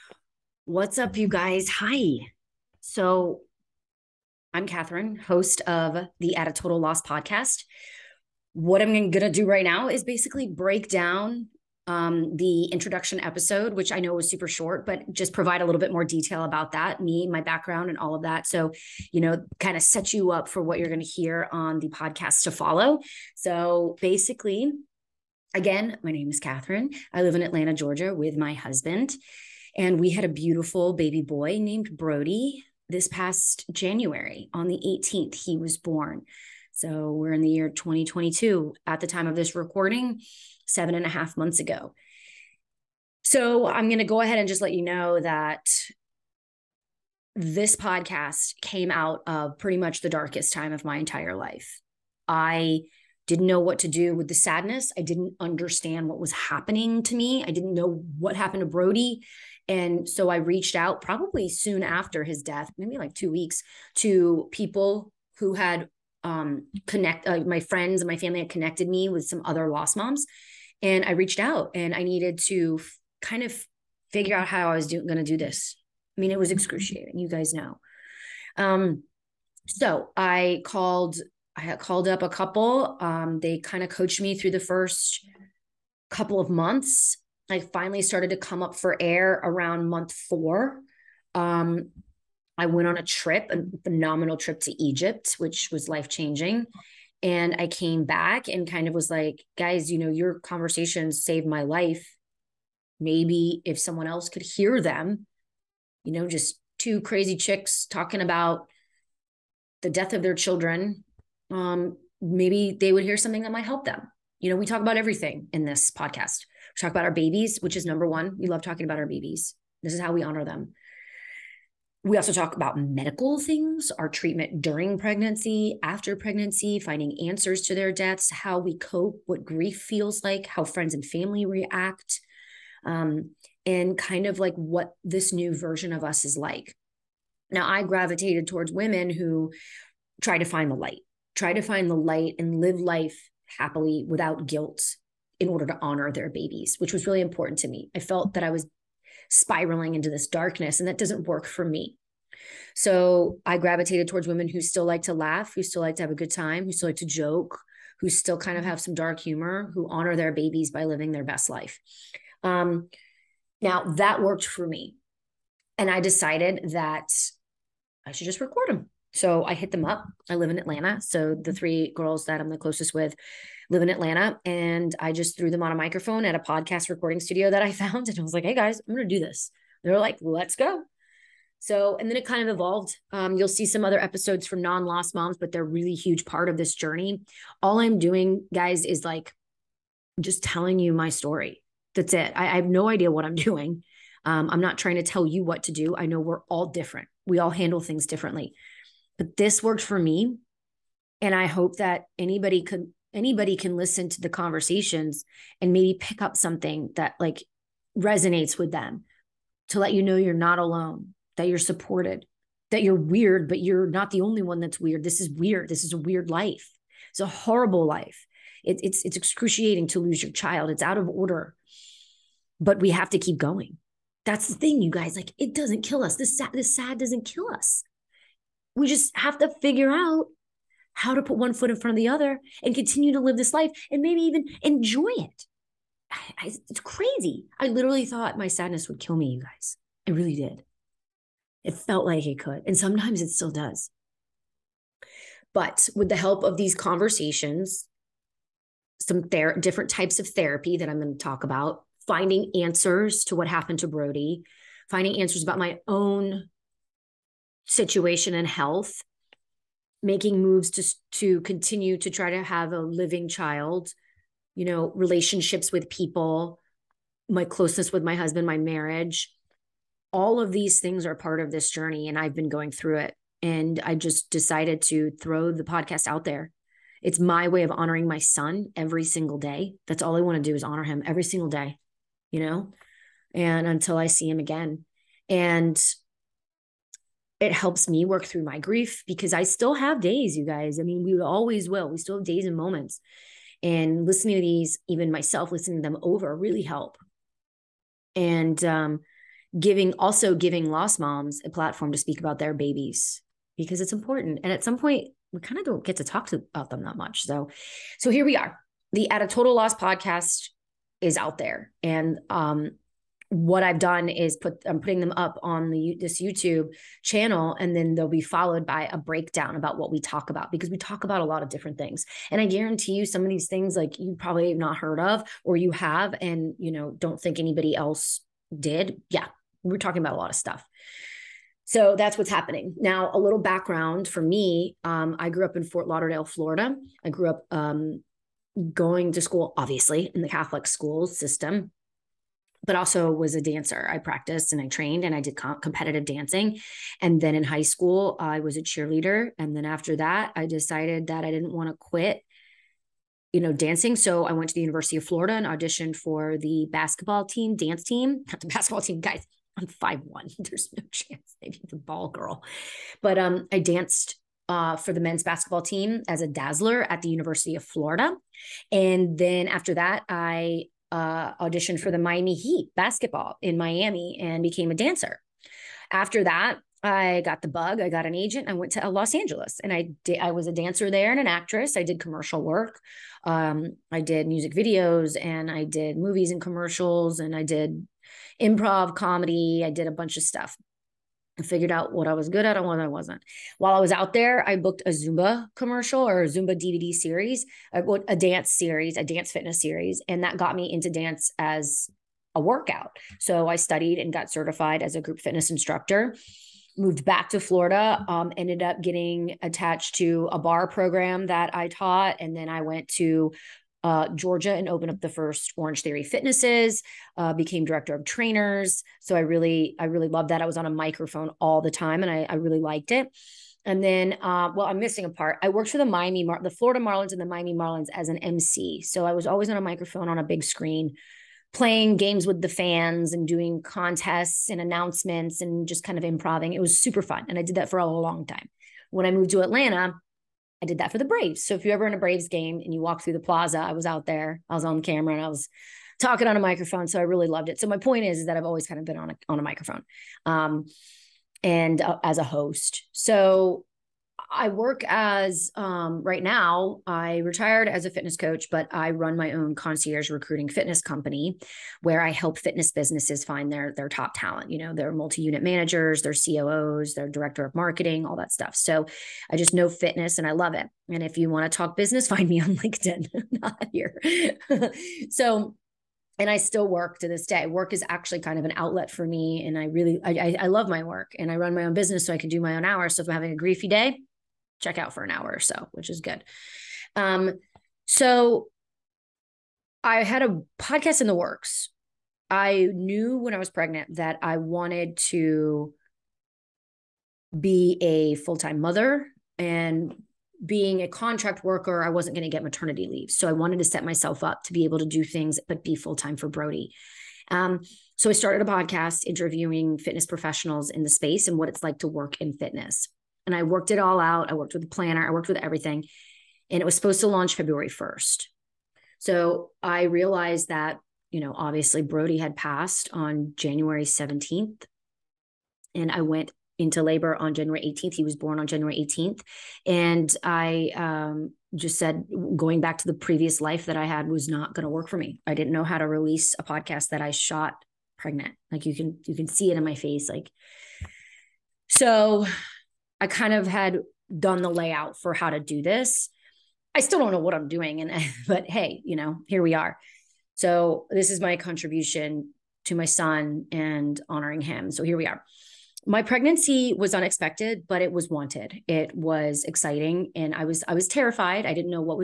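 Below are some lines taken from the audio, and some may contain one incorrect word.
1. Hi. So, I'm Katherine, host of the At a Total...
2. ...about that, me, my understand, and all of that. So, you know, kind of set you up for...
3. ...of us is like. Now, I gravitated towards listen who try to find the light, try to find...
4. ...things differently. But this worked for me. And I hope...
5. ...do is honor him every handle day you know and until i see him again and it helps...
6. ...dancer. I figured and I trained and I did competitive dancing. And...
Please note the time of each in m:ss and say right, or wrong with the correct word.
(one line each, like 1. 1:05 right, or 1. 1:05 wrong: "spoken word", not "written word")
1. 0:01 right
2. 0:16 wrong: "background", not "understand"
3. 2:15 wrong: "women", not "listen"
4. 3:17 right
5. 4:40 wrong: "single", not "handle"
6. 5:43 wrong: "practiced", not "figured".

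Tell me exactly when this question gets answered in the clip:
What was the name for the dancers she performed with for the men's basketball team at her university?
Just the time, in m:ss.
6:06.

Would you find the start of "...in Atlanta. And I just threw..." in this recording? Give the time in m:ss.
2:53.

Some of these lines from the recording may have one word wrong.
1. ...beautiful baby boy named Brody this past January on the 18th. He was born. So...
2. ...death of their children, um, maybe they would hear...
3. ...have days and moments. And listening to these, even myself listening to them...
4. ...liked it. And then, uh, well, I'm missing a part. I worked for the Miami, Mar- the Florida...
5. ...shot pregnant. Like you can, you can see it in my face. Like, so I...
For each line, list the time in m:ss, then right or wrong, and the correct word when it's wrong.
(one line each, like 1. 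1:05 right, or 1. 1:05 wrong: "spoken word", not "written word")
1. 0:30 right
2. 1:49 right
3. 4:52 right
4. 7:02 right
5. 8:57 right.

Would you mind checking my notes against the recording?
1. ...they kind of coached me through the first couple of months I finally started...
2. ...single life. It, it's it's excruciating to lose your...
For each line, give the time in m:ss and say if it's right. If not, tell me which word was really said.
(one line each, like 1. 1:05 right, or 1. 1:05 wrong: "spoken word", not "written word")
1. 1:23 right
2. 3:37 wrong: "horrible", not "single".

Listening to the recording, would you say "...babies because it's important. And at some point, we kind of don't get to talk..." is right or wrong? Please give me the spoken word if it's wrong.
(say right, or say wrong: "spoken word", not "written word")
right.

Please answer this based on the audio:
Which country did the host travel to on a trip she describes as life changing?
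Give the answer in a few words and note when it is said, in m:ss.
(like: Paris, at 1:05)
Egypt, at 1:34.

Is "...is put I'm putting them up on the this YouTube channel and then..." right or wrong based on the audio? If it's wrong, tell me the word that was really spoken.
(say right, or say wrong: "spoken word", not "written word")
right.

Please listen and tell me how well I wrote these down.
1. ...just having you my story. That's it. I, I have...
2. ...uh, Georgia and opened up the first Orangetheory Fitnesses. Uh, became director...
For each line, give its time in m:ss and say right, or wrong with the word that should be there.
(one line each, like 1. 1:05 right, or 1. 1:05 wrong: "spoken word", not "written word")
1. 3:10 wrong: "telling", not "having"
2. 6:53 right.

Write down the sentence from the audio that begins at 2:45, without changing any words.
And I decided that I should just record them.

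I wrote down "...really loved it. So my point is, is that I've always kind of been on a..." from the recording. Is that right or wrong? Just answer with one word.
right.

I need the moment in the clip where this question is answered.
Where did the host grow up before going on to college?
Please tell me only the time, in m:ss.
5:35.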